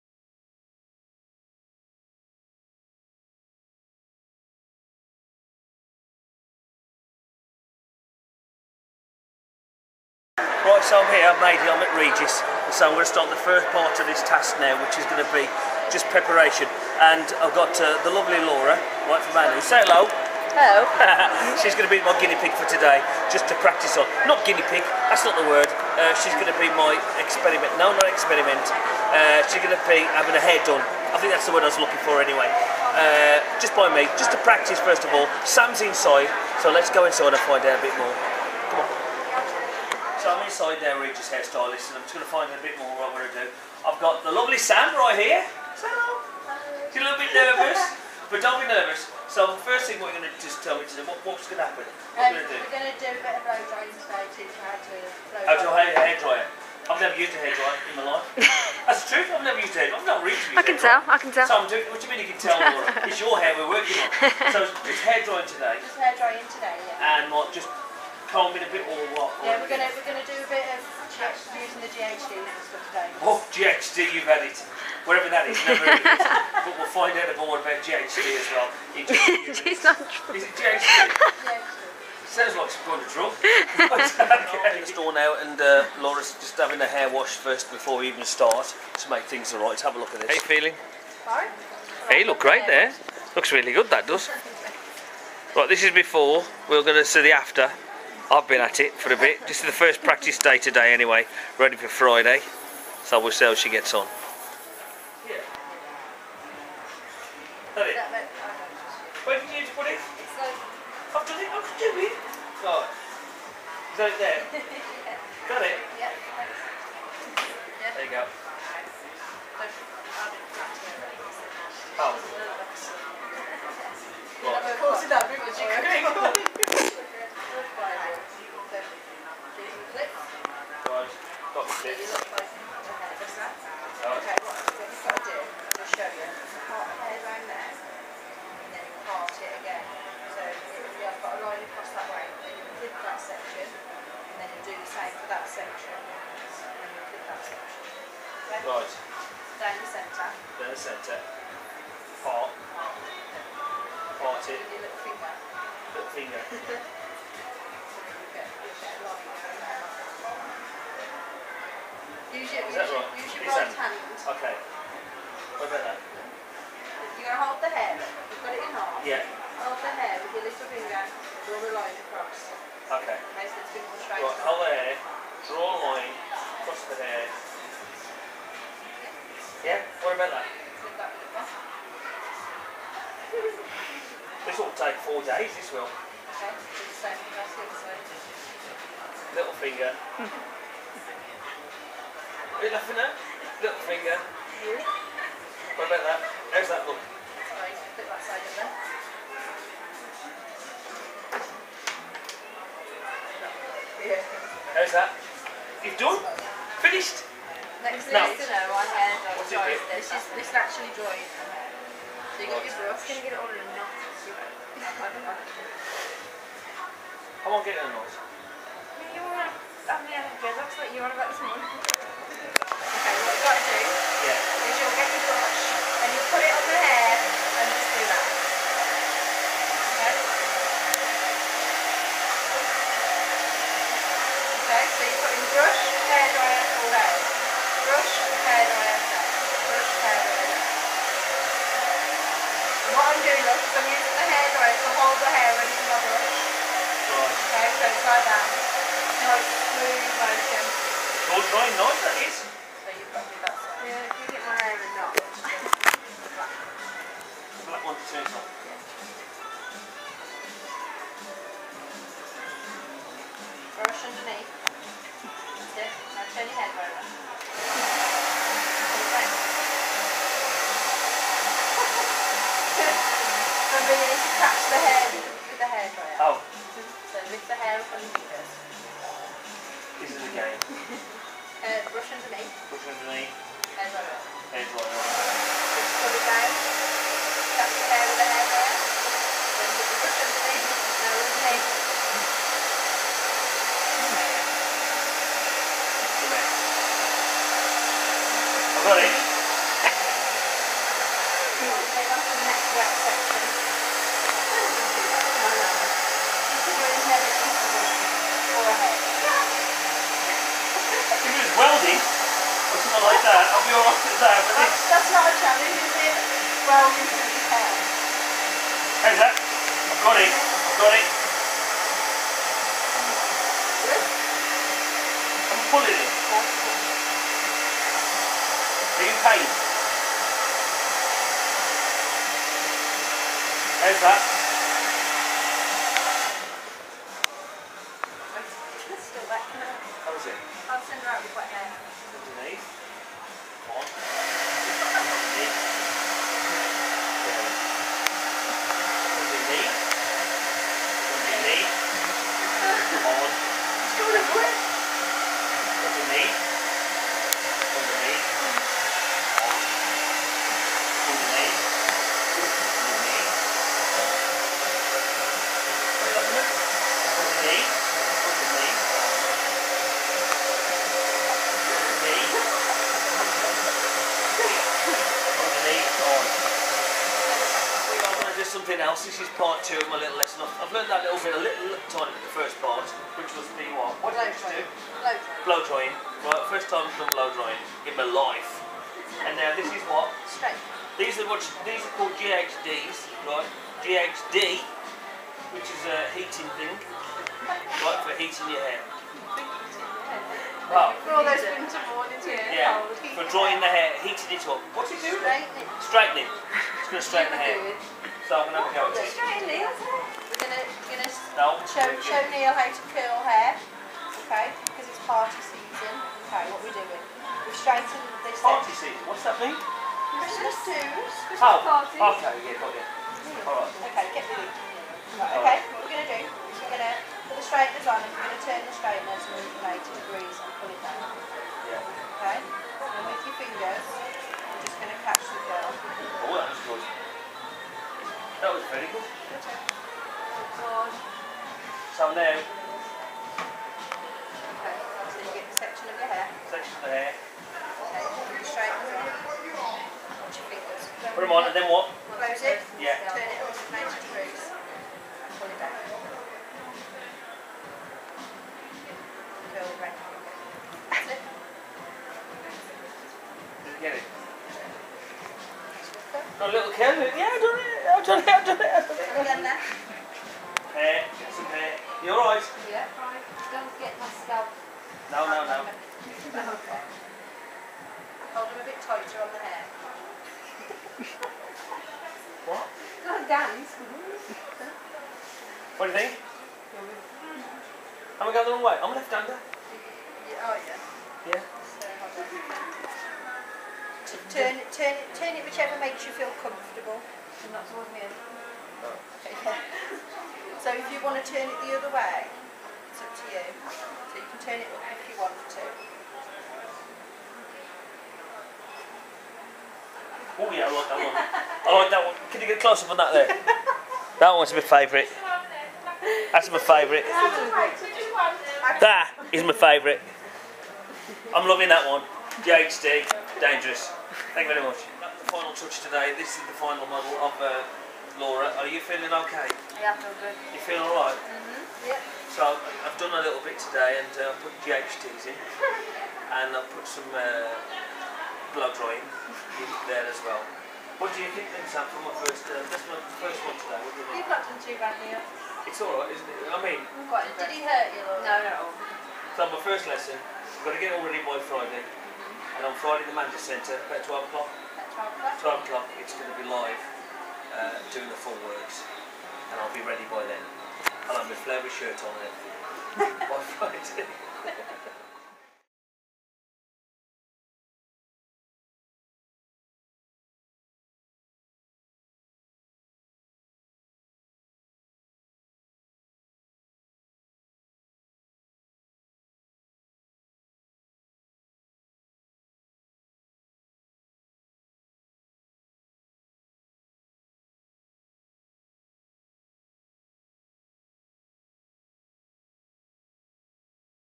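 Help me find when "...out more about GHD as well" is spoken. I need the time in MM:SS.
01:17.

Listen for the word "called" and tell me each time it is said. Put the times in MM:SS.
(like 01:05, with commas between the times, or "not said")
06:31.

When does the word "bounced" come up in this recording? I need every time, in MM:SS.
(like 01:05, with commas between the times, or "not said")
not said.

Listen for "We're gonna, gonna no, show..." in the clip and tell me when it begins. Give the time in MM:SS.
06:49.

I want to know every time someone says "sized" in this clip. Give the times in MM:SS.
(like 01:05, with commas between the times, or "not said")
not said.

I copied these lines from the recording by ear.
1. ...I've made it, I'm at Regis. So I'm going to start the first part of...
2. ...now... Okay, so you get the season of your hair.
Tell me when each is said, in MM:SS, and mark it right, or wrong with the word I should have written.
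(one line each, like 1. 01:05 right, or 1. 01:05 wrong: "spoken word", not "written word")
1. 00:11 right
2. 07:22 wrong: "section", not "season".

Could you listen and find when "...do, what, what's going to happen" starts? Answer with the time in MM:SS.
00:50.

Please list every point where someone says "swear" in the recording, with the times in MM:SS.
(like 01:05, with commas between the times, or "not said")
not said.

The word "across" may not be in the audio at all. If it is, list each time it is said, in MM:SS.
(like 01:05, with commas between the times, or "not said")
02:52, 02:56.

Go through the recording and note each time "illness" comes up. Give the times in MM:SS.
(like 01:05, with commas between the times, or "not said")
not said.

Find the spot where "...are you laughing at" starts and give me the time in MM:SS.
03:12.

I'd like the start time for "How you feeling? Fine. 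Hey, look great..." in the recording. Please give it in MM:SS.
01:30.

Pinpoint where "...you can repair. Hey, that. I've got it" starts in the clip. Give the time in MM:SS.
05:16.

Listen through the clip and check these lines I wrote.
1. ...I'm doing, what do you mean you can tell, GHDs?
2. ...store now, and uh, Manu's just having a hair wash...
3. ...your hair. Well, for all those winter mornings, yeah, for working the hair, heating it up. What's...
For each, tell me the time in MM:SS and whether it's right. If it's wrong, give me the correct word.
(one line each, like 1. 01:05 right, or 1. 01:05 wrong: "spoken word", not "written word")
1. 01:01 wrong: "Laura", not "GHDs"
2. 01:24 wrong: "Laura", not "Manu"
3. 06:38 wrong: "drying", not "working".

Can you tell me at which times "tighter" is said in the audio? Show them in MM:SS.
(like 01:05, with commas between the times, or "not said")
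07:58.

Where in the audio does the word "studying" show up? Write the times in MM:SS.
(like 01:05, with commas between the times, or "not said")
not said.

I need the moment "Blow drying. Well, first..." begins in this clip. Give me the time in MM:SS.
06:25.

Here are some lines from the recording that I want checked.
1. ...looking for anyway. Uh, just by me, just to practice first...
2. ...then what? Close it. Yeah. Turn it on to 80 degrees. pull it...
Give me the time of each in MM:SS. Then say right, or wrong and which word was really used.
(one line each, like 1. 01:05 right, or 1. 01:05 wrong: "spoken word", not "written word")
1. 00:31 right
2. 07:31 wrong: "90", not "80".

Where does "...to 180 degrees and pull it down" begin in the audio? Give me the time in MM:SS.
07:09.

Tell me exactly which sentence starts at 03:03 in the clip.
this will take four days, this will.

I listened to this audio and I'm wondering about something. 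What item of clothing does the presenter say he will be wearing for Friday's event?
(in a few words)
Flare shirt.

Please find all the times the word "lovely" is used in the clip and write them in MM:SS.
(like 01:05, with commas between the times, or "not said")
00:18, 00:44.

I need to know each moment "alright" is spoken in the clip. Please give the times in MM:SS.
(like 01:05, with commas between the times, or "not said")
01:29, 05:13, 07:52, 08:50, 09:05.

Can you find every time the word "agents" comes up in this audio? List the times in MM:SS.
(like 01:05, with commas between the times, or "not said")
not said.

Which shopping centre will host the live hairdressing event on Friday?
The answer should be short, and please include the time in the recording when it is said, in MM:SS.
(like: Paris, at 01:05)
Mander Centre, at 09:13.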